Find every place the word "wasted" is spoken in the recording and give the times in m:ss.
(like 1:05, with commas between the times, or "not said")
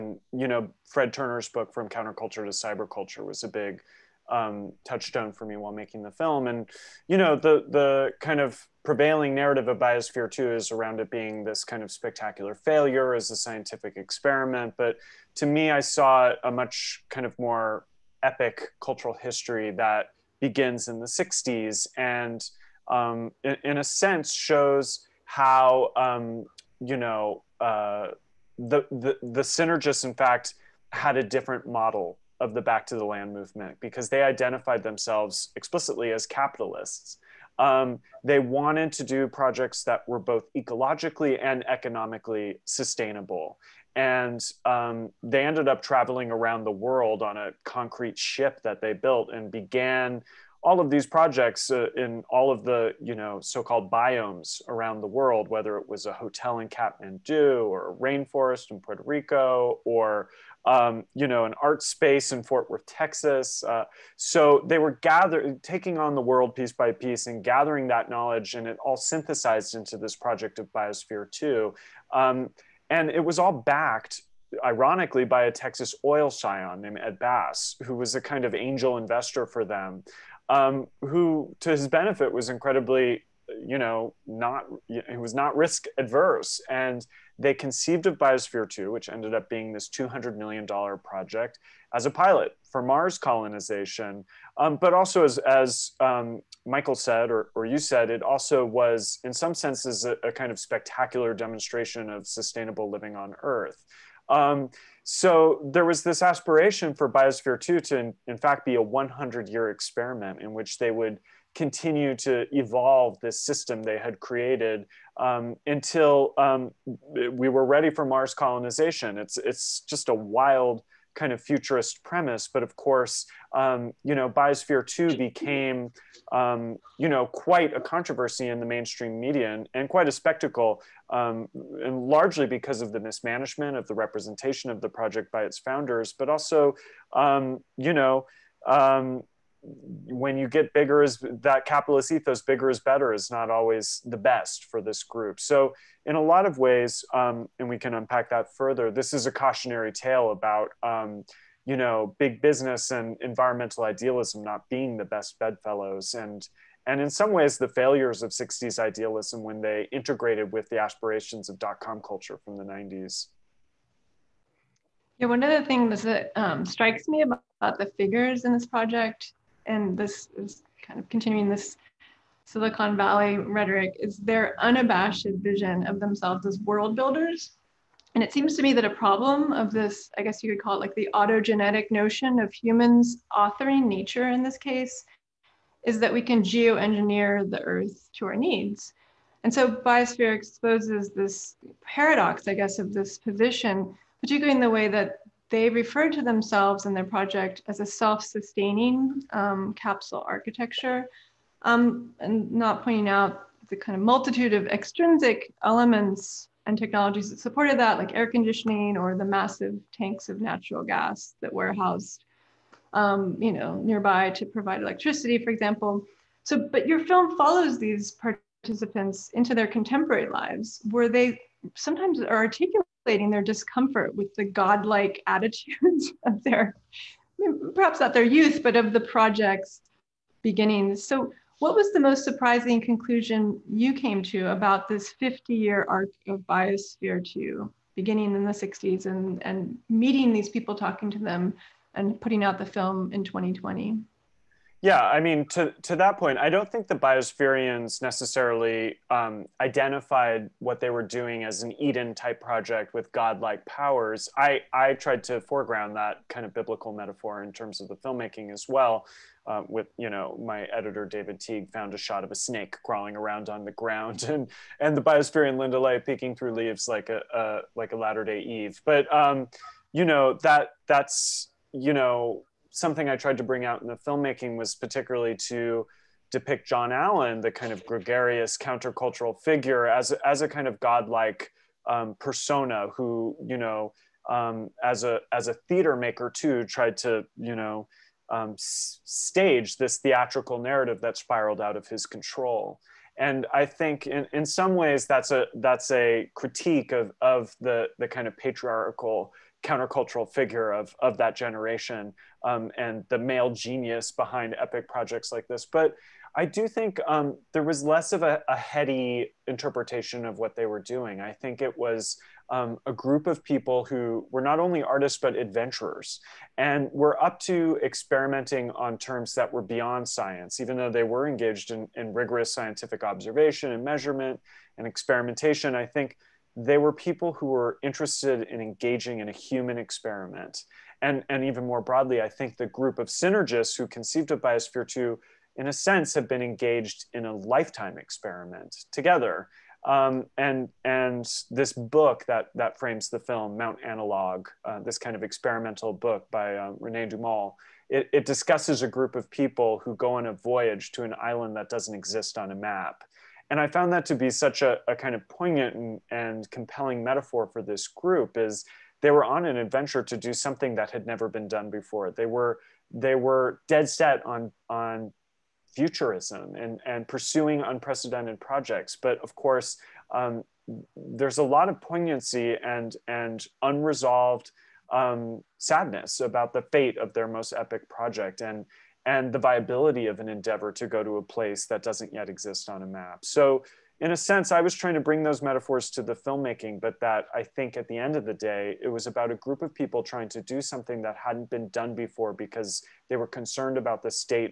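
not said.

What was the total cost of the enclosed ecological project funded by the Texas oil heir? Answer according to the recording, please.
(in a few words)
$200 million.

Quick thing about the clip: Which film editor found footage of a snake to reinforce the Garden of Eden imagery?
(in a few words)
David Teague.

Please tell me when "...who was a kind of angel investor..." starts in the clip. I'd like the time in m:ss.
1:17.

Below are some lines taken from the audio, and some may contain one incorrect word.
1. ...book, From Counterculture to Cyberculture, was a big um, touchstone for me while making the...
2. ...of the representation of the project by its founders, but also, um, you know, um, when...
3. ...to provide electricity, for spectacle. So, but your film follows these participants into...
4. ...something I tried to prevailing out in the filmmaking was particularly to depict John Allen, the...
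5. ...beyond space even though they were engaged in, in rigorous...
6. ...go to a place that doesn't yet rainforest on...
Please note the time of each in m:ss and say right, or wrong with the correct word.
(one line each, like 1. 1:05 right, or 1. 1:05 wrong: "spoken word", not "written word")
1. 0:01 right
2. 2:13 right
3. 3:34 wrong: "example", not "spectacle"
4. 4:32 wrong: "bring", not "prevailing"
5. 5:19 wrong: "science", not "space"
6. 6:20 wrong: "exist", not "rainforest".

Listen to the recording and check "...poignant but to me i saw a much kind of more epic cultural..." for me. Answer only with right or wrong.
wrong.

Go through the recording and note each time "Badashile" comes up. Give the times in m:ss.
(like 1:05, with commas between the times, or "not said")
not said.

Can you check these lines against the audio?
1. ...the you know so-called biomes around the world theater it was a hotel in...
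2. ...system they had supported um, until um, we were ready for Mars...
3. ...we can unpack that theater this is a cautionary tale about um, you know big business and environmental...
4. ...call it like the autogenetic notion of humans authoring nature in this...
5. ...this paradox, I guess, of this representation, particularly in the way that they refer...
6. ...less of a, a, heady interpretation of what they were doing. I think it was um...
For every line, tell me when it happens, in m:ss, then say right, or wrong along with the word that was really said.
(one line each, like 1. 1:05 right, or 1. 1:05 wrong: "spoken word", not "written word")
1. 0:52 wrong: "whether", not "theater"
2. 1:53 wrong: "created", not "supported"
3. 2:27 wrong: "further", not "theater"
4. 3:00 right
5. 3:11 wrong: "position", not "representation"
6. 5:07 right.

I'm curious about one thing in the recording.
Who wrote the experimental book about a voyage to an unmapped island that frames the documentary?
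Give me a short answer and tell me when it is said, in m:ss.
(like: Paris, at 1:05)
René Daumal, at 5:46.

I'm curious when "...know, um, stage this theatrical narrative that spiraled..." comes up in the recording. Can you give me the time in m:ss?
4:47.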